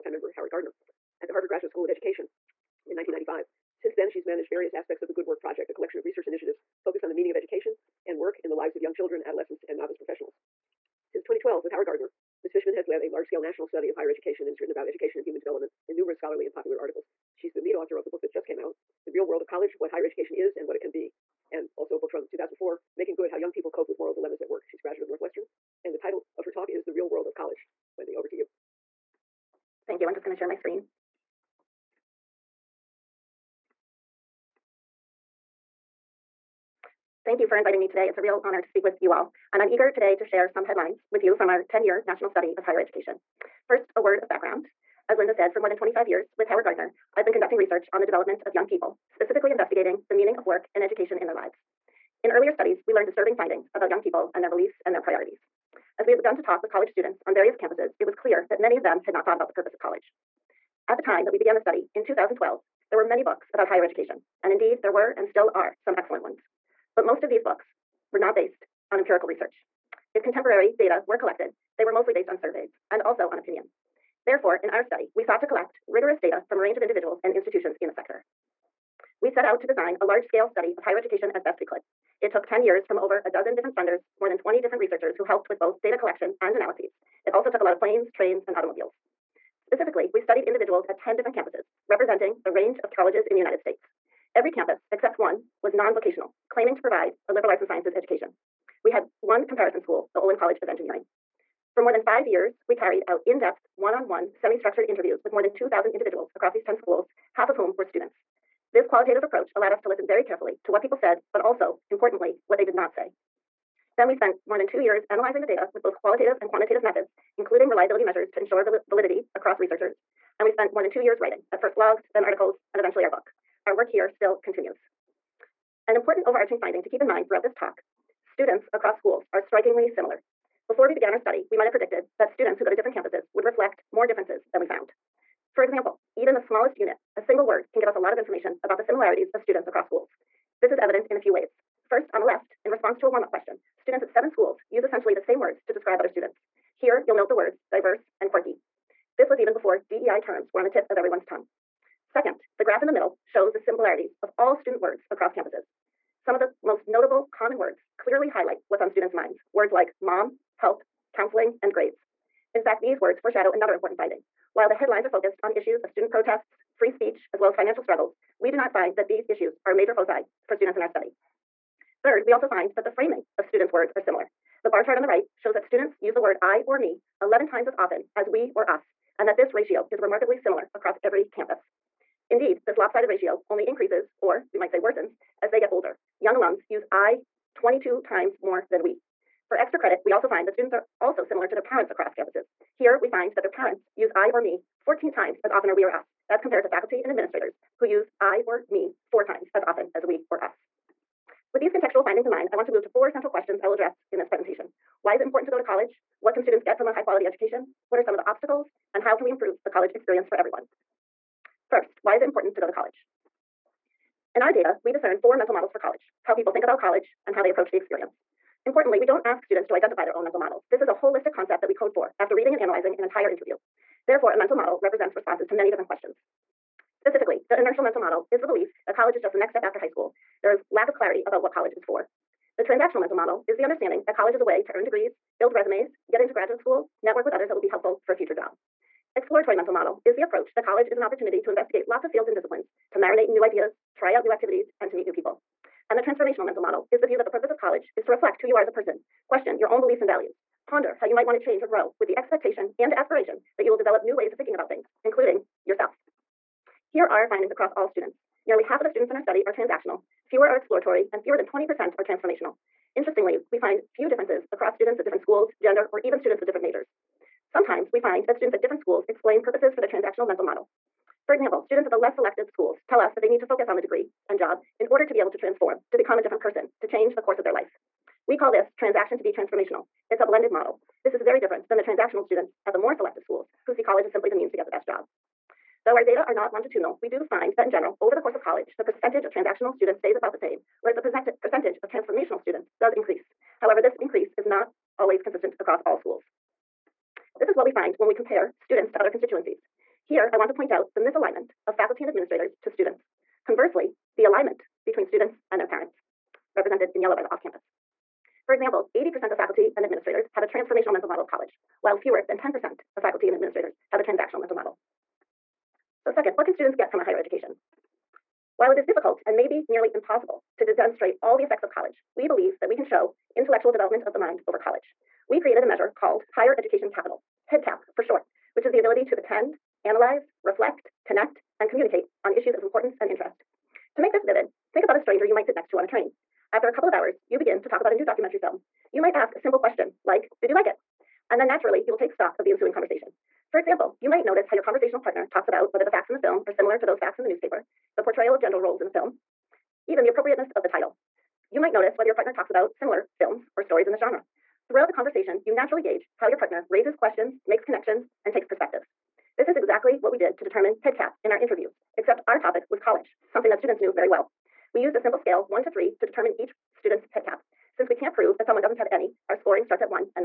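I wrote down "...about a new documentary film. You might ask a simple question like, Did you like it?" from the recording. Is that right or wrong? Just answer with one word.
right.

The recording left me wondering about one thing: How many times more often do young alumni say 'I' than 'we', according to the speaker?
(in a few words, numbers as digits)
22.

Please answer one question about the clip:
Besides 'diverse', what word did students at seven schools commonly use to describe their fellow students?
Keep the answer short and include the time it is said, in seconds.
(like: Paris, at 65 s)
quirky, at 148 s.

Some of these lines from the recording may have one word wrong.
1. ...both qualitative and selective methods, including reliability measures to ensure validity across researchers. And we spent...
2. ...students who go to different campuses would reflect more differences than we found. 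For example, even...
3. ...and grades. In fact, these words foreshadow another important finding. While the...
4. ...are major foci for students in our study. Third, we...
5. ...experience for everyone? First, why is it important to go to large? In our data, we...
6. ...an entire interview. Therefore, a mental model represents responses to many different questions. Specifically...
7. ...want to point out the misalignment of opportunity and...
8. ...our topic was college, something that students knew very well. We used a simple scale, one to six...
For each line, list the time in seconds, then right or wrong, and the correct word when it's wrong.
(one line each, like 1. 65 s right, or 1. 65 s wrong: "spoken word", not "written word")
1. 115 s wrong: "quantitative", not "selective"
2. 132 s right
3. 161 s right
4. 169 s right
5. 209 s wrong: "college", not "large"
6. 222 s right
7. 300 s wrong: "faculty", not "opportunity"
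8. 362 s wrong: "three", not "six".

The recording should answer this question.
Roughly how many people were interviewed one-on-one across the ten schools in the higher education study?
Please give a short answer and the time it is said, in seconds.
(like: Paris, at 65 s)
2,000, at 105 s.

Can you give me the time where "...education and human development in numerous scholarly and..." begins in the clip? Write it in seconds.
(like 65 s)
14 s.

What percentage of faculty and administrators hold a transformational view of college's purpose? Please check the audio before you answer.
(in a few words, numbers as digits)
80%.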